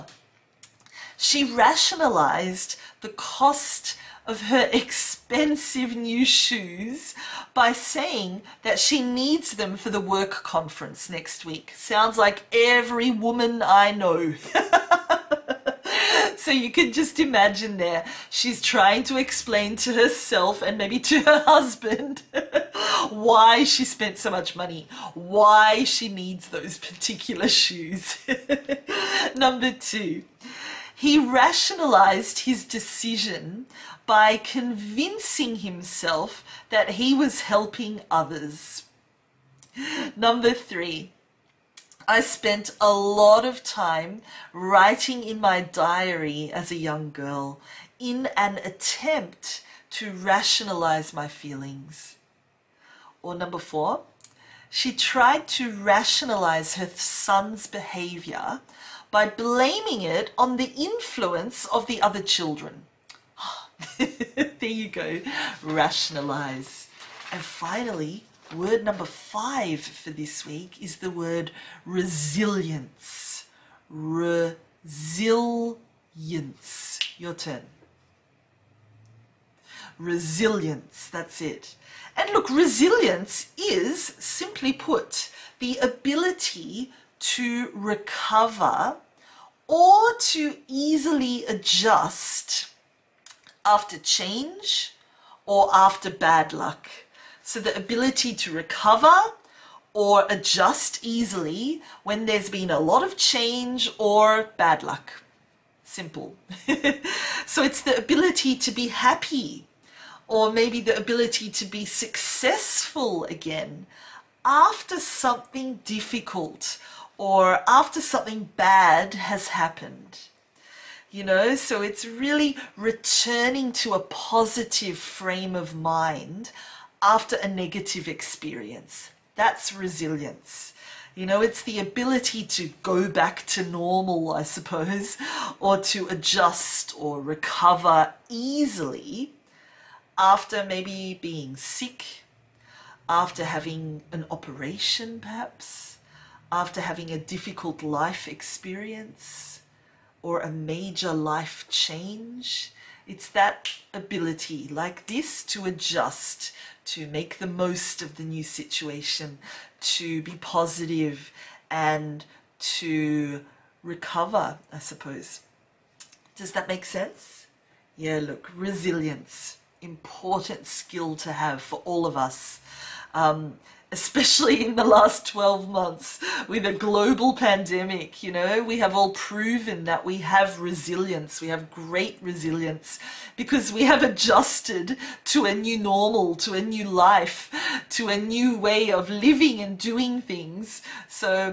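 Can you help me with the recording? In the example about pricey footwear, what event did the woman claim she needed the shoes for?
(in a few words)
work conference.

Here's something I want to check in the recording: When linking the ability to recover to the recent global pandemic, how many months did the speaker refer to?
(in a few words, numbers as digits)
12.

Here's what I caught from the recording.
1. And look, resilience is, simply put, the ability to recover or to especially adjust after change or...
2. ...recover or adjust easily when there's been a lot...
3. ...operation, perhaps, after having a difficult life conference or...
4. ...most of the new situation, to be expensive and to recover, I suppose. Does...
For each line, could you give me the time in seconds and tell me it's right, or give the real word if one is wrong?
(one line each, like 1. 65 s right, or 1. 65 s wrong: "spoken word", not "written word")
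1. 82 s wrong: "easily", not "especially"
2. 98 s right
3. 144 s wrong: "experience", not "conference"
4. 157 s wrong: "positive", not "expensive".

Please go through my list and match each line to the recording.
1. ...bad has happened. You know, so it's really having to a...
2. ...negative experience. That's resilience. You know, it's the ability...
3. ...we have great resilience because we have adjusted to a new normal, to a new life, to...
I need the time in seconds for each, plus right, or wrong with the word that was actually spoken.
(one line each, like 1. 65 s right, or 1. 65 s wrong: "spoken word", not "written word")
1. 118 s wrong: "returning", not "having"
2. 127 s right
3. 181 s right.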